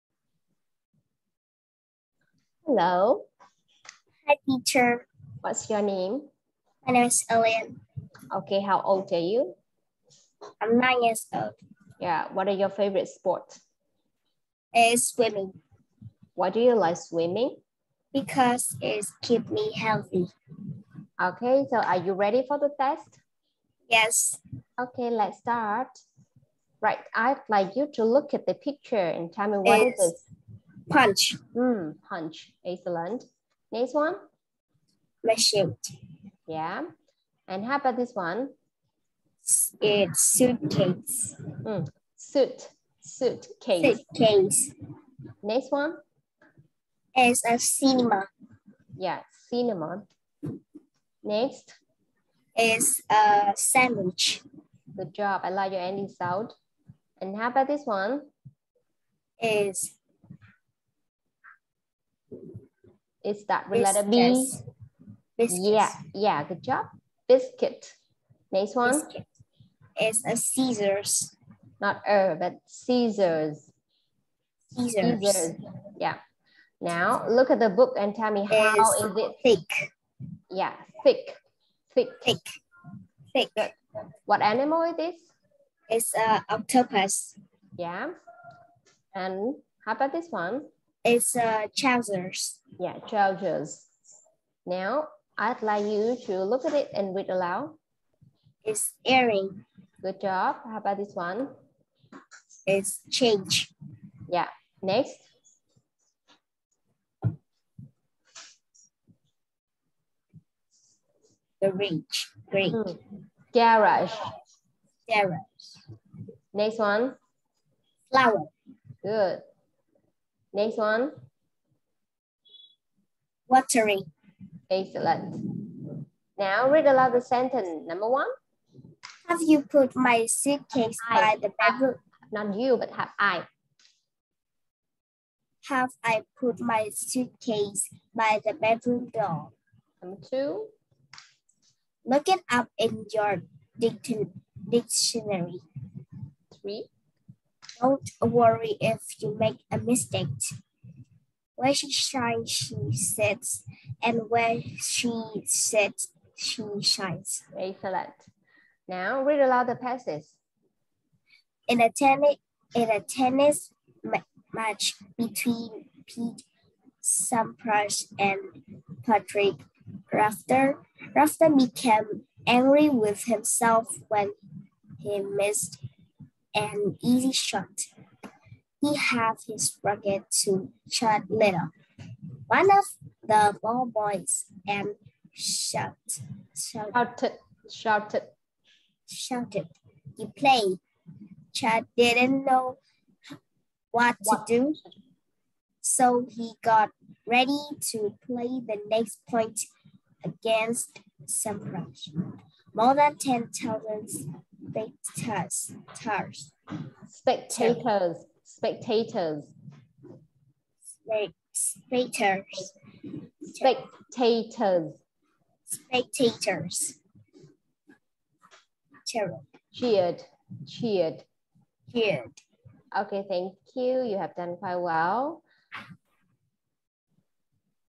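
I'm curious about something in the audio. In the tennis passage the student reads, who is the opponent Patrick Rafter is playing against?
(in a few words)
Pete Sampras.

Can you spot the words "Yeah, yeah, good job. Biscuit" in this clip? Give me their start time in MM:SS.
01:05.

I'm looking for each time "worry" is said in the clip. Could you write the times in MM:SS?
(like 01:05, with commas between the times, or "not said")
02:28.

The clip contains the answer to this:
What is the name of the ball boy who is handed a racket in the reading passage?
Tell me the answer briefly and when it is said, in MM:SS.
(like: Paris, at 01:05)
Chad Little, at 03:00.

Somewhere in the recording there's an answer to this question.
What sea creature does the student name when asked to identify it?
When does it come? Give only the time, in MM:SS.
01:25.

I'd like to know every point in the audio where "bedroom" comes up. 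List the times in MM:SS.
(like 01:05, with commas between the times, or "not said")
02:11, 02:18.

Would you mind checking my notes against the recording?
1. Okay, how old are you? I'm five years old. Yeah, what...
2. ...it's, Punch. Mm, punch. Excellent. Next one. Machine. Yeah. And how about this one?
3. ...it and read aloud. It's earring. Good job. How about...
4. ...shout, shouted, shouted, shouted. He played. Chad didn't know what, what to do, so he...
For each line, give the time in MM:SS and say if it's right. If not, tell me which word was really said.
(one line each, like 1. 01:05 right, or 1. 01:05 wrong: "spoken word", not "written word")
1. 00:08 wrong: "nine", not "five"
2. 00:29 right
3. 01:36 right
4. 03:06 right.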